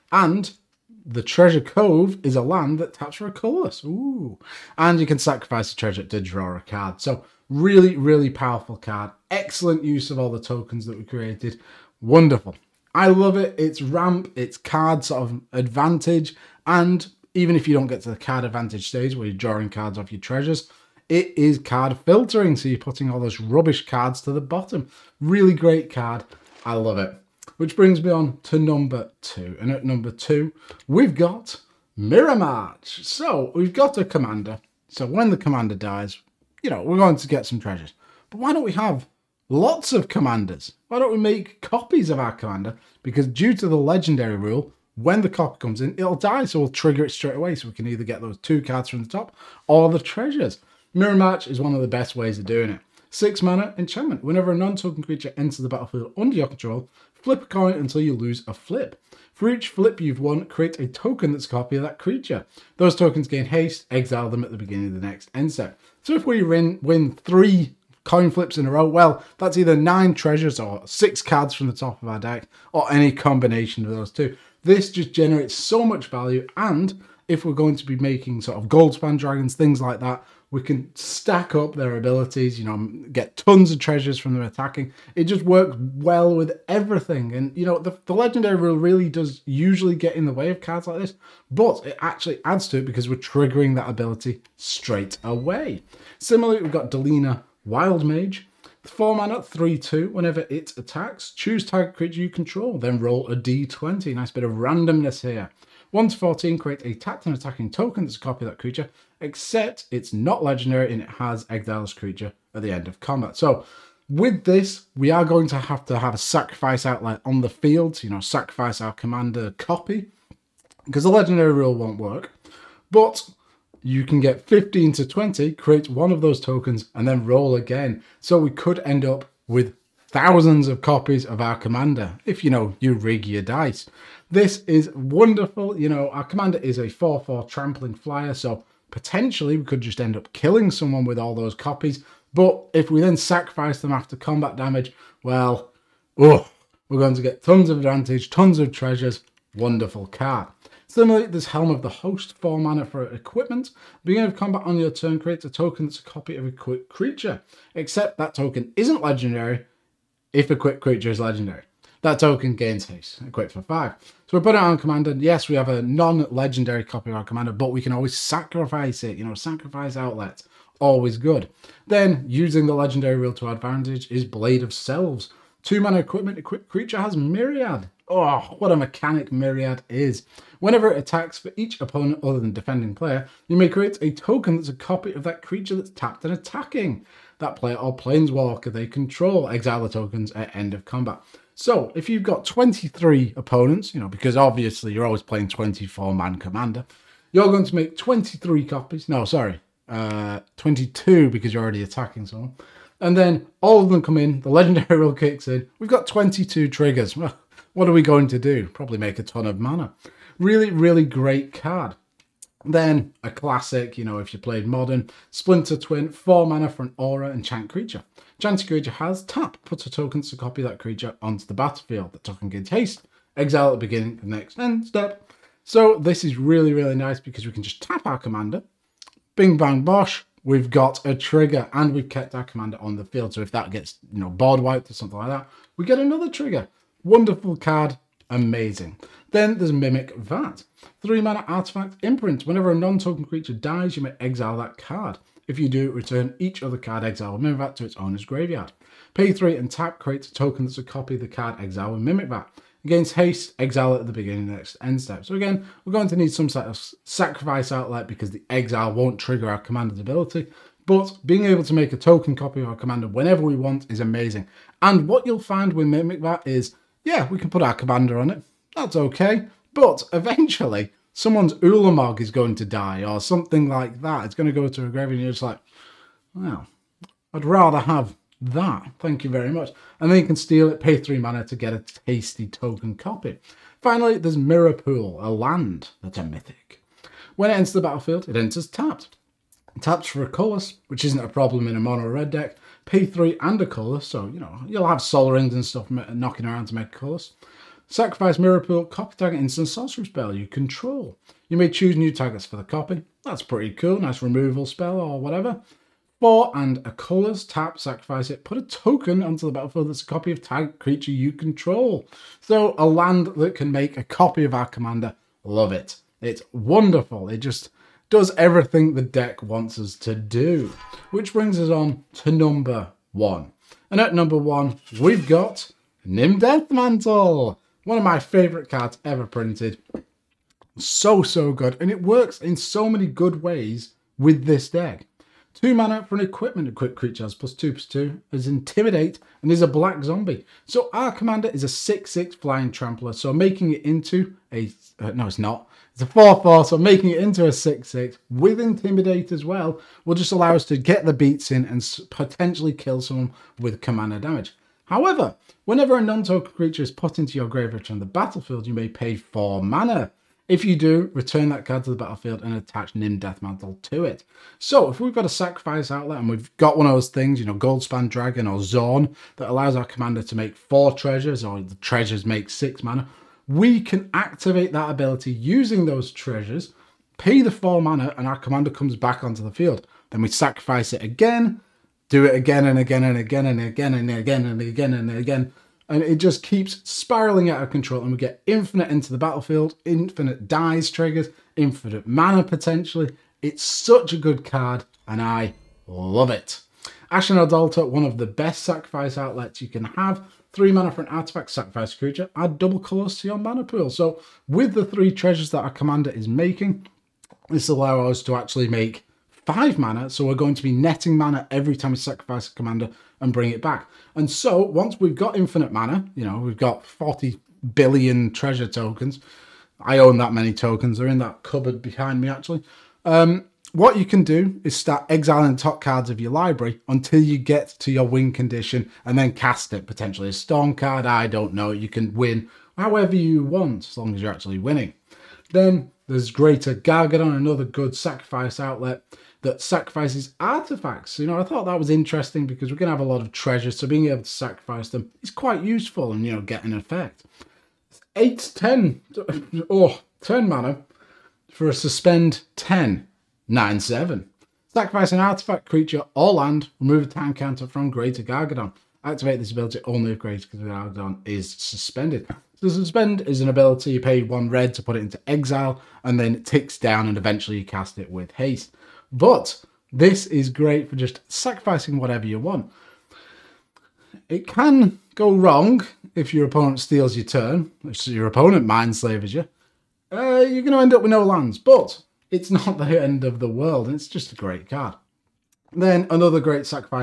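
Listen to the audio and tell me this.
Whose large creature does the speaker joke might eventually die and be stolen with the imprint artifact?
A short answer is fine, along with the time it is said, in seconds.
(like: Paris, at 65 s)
Ulamog, at 271 s.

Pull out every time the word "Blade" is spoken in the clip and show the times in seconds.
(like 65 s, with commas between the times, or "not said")
174 s.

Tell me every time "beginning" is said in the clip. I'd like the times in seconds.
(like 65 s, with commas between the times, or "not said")
64 s, 154 s, 223 s, 254 s.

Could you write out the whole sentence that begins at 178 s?
Oh, what a mechanic Myriad is.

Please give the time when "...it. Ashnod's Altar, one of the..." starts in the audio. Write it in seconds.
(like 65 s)
396 s.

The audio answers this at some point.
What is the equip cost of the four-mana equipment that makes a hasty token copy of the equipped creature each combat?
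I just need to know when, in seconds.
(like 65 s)
163 s.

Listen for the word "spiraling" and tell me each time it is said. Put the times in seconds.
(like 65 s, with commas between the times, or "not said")
386 s.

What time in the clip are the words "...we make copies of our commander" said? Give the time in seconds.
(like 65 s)
41 s.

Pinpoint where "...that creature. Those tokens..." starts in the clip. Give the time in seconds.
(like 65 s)
61 s.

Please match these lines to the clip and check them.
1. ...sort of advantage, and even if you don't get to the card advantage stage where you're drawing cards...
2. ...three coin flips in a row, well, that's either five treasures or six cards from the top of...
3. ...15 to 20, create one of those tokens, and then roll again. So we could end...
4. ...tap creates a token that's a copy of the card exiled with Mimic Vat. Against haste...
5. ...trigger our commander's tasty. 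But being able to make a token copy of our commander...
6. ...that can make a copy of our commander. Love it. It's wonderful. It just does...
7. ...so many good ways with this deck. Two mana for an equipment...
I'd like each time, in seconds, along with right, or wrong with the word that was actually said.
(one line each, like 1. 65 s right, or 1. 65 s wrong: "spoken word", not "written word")
1. 15 s right
2. 67 s wrong: "nine", not "five"
3. 124 s right
4. 249 s right
5. 259 s wrong: "ability", not "tasty"
6. 313 s right
7. 332 s right.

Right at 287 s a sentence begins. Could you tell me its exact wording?
When it enters the battlefield, it enters tapped.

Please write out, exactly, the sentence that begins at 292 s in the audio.
Pay three and a color, so you know you'll have Sol Rings and stuff knocking around to make colors.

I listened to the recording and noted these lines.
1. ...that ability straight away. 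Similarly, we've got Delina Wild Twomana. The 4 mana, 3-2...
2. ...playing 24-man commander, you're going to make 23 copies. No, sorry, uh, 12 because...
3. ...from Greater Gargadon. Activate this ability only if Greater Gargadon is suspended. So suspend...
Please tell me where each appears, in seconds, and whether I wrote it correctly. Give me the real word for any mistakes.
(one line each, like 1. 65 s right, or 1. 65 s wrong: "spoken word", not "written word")
1. 93 s wrong: "Mage", not "Twomana"
2. 195 s wrong: "22", not "12"
3. 457 s right.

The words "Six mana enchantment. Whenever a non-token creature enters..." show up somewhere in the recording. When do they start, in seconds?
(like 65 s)
53 s.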